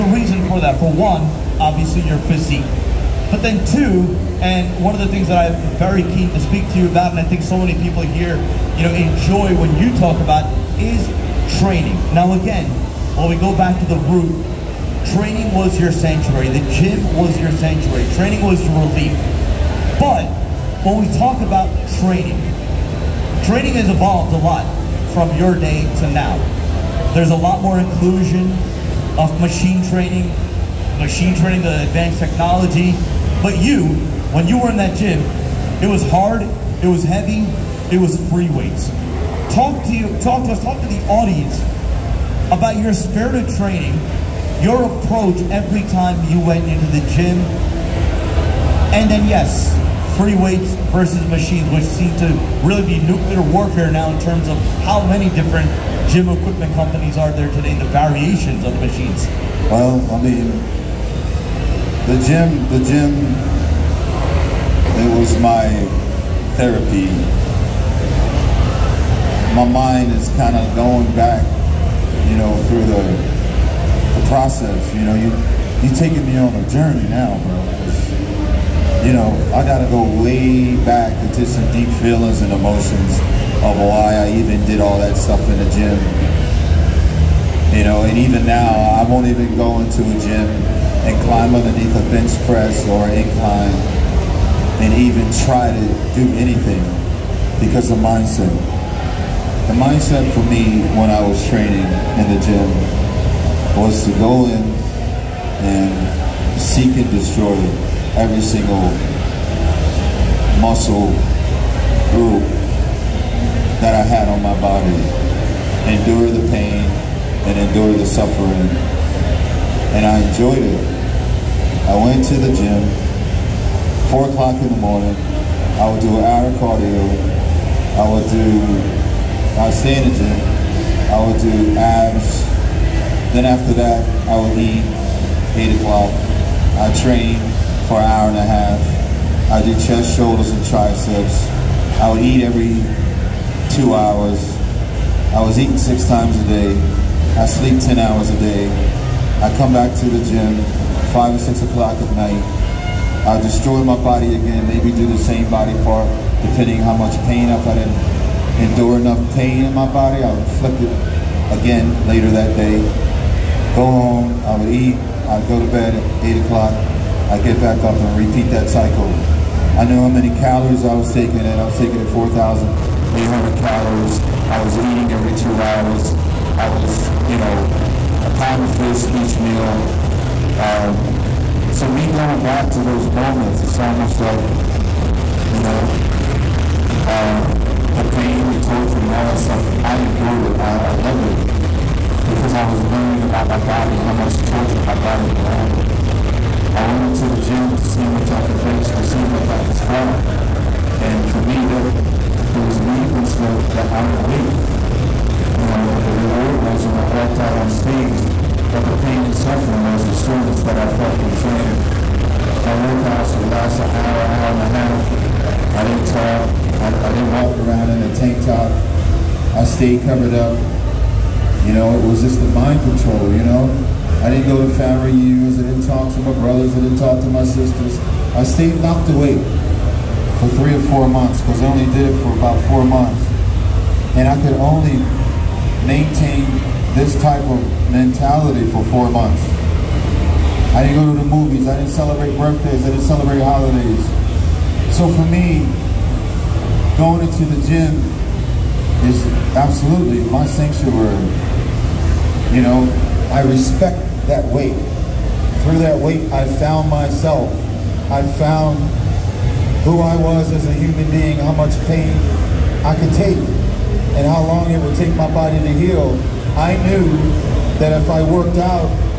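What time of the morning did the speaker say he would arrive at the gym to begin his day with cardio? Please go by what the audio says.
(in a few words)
4 o'clock.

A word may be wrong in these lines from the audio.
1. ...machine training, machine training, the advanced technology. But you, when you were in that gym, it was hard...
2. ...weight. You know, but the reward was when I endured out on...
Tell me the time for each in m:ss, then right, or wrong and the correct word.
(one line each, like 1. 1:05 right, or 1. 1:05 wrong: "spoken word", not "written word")
1. 0:29 right
2. 3:24 wrong: "walked", not "endured".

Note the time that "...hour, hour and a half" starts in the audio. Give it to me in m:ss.
3:33.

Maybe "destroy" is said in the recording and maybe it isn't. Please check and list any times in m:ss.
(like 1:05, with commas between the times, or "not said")
1:47, 2:33.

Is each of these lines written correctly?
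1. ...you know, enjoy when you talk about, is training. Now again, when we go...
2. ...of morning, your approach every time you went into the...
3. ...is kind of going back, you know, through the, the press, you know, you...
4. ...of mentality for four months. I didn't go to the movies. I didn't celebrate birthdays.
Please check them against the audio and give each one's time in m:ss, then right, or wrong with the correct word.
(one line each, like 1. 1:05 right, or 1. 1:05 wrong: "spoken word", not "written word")
1. 0:08 right
2. 0:43 wrong: "training", not "morning"
3. 1:10 wrong: "process", not "press"
4. 3:57 right.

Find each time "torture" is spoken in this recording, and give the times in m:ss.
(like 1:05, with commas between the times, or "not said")
3:08, 3:14.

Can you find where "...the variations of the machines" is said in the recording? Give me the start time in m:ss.
0:57.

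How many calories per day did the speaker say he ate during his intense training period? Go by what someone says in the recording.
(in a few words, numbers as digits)
4,800.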